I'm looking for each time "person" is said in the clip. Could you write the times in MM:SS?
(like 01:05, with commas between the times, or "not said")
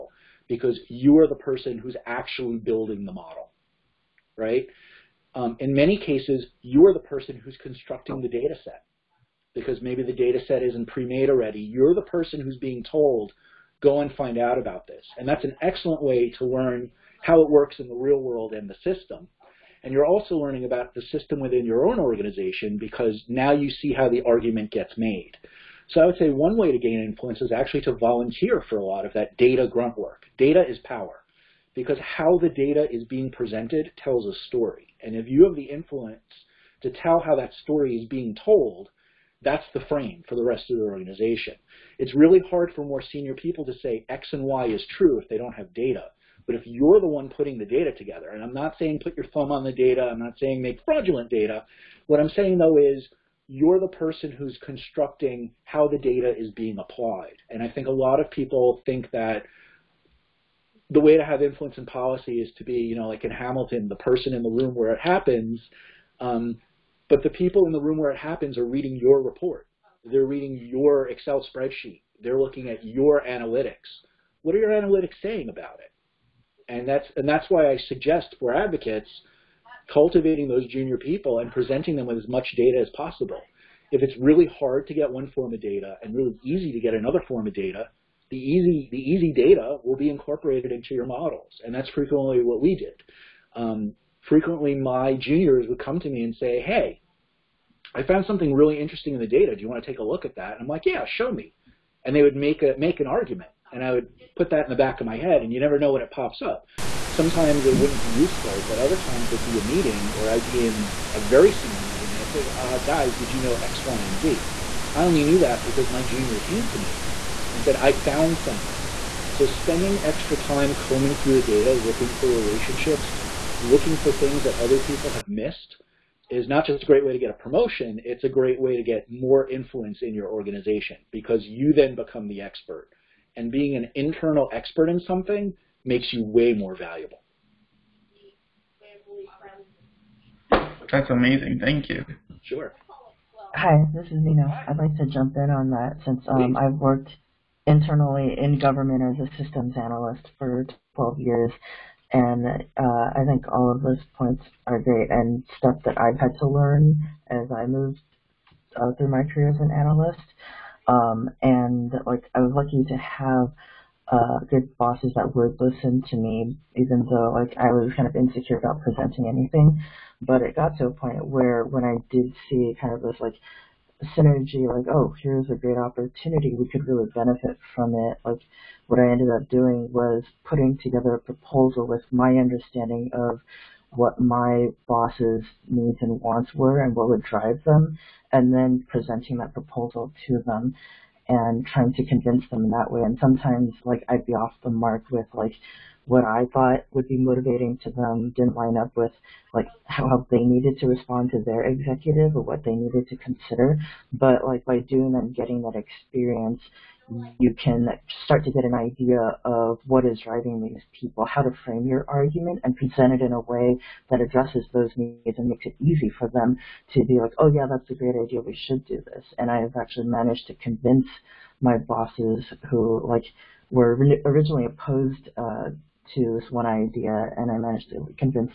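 00:01, 00:06, 00:12, 00:53, 01:03.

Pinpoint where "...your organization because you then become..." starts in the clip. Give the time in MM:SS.
02:10.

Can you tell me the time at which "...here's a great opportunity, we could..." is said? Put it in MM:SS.
02:55.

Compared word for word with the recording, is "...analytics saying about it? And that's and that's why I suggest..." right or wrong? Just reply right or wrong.
right.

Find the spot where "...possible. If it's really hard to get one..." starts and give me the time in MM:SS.
01:22.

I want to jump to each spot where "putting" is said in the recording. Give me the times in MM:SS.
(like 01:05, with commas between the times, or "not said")
00:47, 03:00.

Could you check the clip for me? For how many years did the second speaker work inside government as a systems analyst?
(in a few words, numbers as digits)
12.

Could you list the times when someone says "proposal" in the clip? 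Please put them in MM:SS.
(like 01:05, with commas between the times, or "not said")
03:01, 03:09.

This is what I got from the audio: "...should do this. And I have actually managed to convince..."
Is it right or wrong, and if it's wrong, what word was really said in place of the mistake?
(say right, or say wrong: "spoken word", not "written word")
right.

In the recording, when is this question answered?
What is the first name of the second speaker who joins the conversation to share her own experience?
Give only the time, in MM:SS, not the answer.
02:24.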